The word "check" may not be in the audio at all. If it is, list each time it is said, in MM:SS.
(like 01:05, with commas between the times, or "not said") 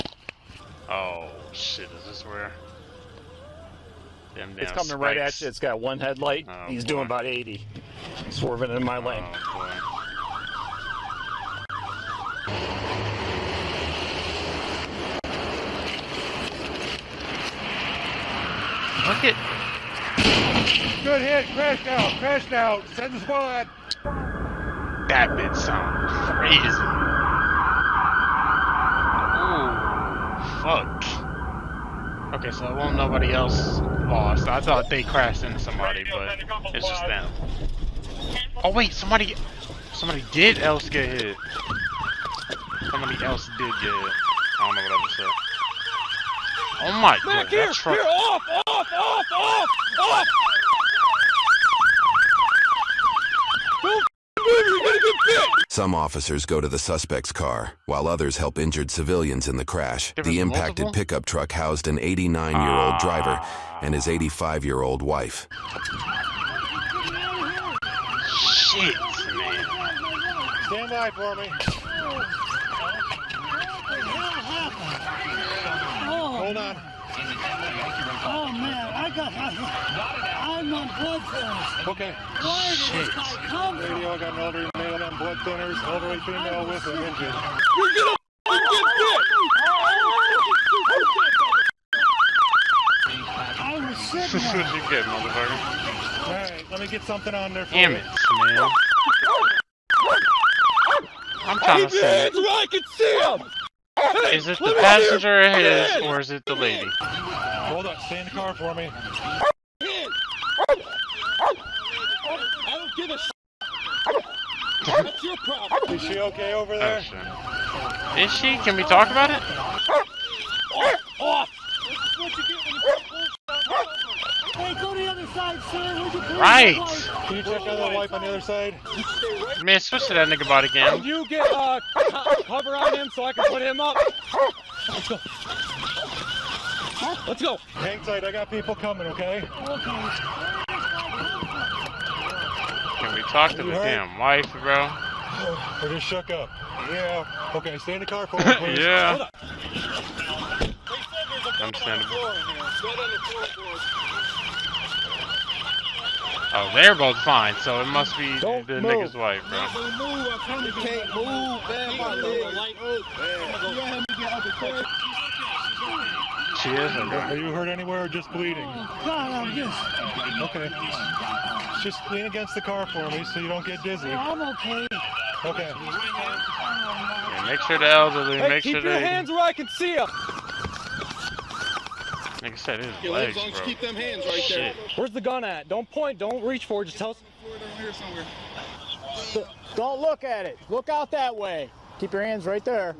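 02:07.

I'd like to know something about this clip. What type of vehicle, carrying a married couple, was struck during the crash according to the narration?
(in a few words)
pickup truck.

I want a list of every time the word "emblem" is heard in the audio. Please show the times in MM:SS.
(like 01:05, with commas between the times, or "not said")
not said.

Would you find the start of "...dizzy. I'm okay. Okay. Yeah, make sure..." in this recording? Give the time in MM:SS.
02:53.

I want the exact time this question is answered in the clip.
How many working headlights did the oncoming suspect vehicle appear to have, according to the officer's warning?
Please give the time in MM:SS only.
00:05.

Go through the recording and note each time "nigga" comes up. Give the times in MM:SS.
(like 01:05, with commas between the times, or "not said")
02:10, 02:38.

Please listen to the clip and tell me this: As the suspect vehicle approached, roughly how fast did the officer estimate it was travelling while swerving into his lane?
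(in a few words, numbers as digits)
80.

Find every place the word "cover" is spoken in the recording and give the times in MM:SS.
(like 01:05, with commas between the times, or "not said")
02:12.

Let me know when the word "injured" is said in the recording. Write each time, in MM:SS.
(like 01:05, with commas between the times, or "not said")
00:58, 01:27.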